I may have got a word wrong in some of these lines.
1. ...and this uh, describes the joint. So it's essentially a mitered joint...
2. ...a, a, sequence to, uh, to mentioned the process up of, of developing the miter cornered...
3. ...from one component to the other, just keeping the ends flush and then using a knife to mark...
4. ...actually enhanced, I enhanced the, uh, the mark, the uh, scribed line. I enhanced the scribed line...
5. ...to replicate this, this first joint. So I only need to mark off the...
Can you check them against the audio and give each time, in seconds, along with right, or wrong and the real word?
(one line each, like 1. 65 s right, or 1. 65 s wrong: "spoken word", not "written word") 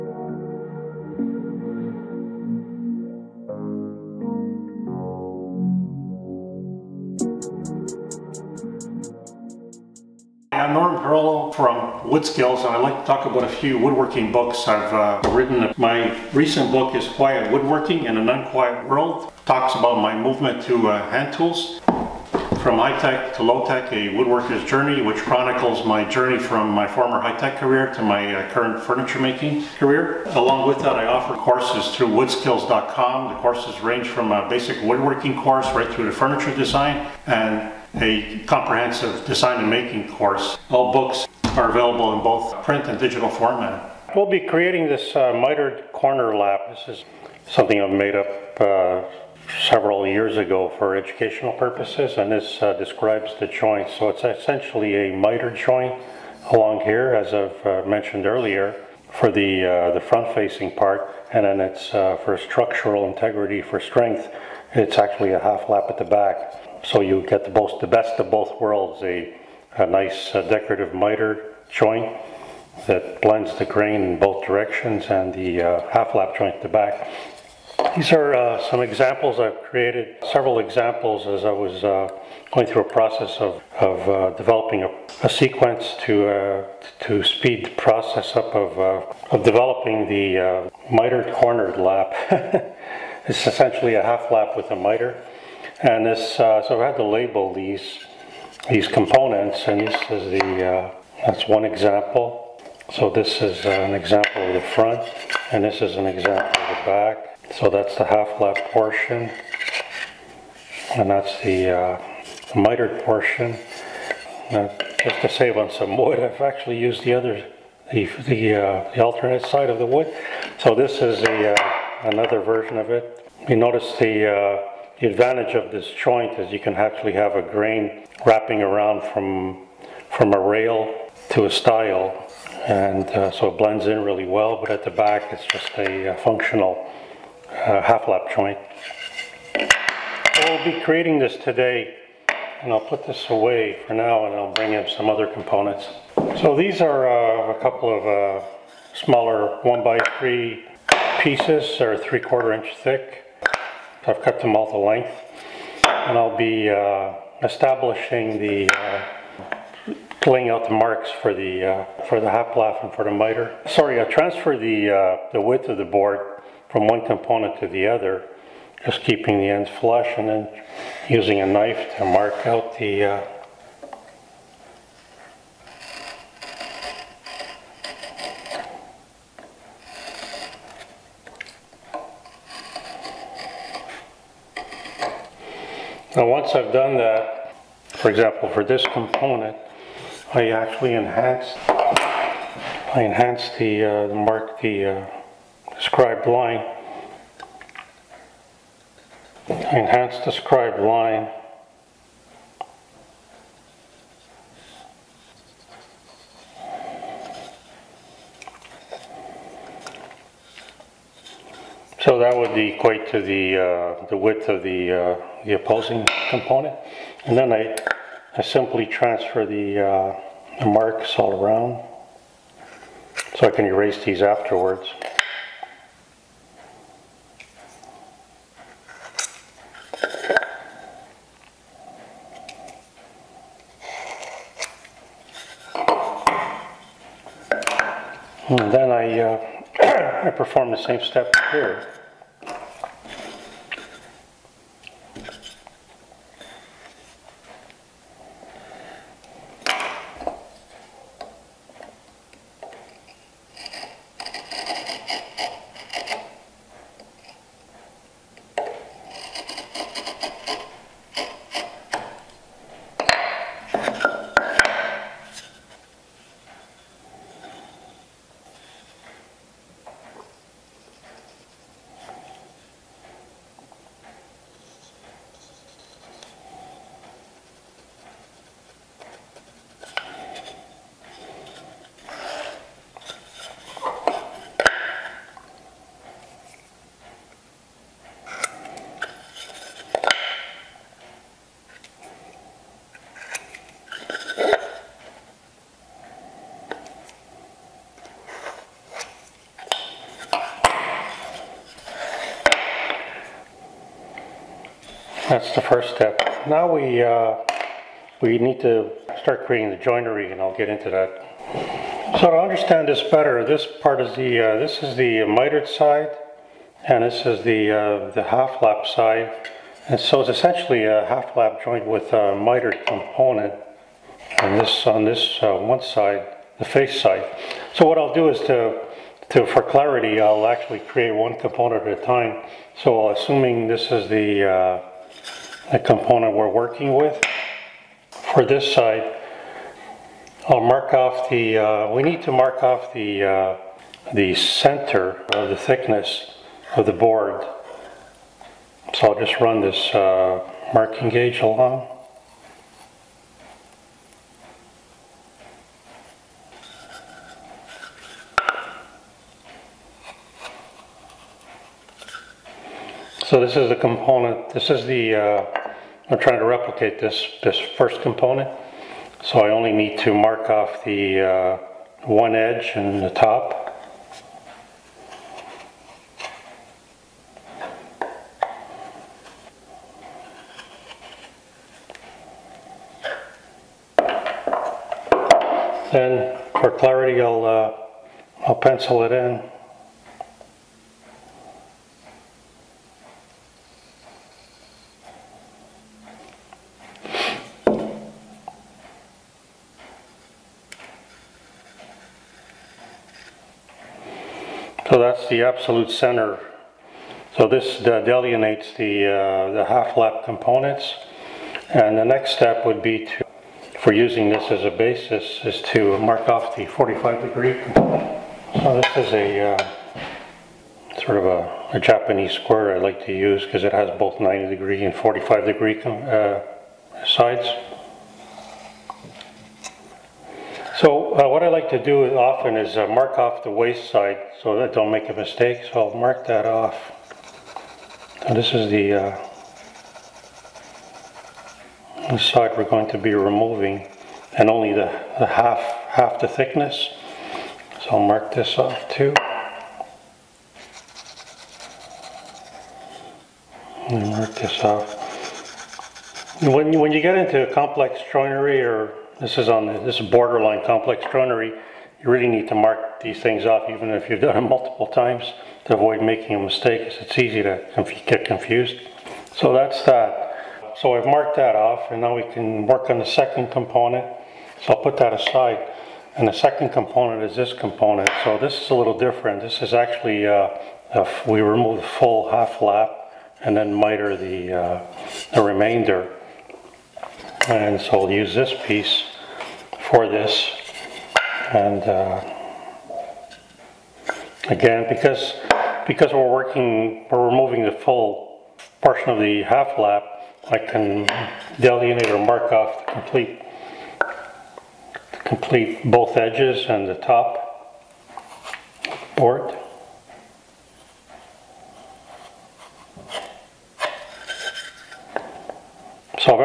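1. 52 s right
2. 84 s wrong: "speed", not "mentioned"
3. 166 s right
4. 190 s right
5. 366 s wrong: "component", not "joint".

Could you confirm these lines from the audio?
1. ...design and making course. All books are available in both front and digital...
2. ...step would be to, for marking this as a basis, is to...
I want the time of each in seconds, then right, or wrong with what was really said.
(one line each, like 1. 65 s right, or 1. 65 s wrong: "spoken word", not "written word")
1. 39 s wrong: "print", not "front"
2. 412 s wrong: "using", not "marking".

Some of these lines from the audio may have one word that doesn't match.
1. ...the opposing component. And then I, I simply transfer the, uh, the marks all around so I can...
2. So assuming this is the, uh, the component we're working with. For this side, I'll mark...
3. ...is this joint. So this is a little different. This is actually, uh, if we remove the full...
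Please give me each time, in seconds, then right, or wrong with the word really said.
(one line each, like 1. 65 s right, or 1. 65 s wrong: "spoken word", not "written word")
1. 215 s right
2. 332 s right
3. 477 s wrong: "component", not "joint".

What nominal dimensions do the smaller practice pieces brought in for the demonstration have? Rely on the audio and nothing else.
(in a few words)
1 by 3.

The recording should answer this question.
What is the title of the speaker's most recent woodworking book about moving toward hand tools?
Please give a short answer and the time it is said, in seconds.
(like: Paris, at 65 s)
Quiet Woodworking in an Unquiet World, at 17 s.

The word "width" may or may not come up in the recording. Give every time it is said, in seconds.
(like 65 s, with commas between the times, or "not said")
165 s, 214 s.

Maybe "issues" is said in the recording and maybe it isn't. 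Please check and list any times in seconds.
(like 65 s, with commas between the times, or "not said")
not said.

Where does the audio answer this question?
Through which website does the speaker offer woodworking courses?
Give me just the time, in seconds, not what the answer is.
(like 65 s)
32 s.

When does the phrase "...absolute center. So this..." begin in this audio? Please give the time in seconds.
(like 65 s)
405 s.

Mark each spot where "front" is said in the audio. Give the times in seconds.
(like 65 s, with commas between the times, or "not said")
59 s, 104 s.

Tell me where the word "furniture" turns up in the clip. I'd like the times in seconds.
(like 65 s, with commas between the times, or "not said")
28 s, 36 s.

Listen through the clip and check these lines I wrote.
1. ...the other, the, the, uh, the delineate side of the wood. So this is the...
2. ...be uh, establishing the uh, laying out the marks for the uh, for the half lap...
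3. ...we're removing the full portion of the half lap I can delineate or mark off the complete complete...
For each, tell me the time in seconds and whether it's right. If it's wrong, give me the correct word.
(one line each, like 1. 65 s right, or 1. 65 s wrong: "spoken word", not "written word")
1. 117 s wrong: "alternate", not "delineate"
2. 156 s right
3. 497 s right.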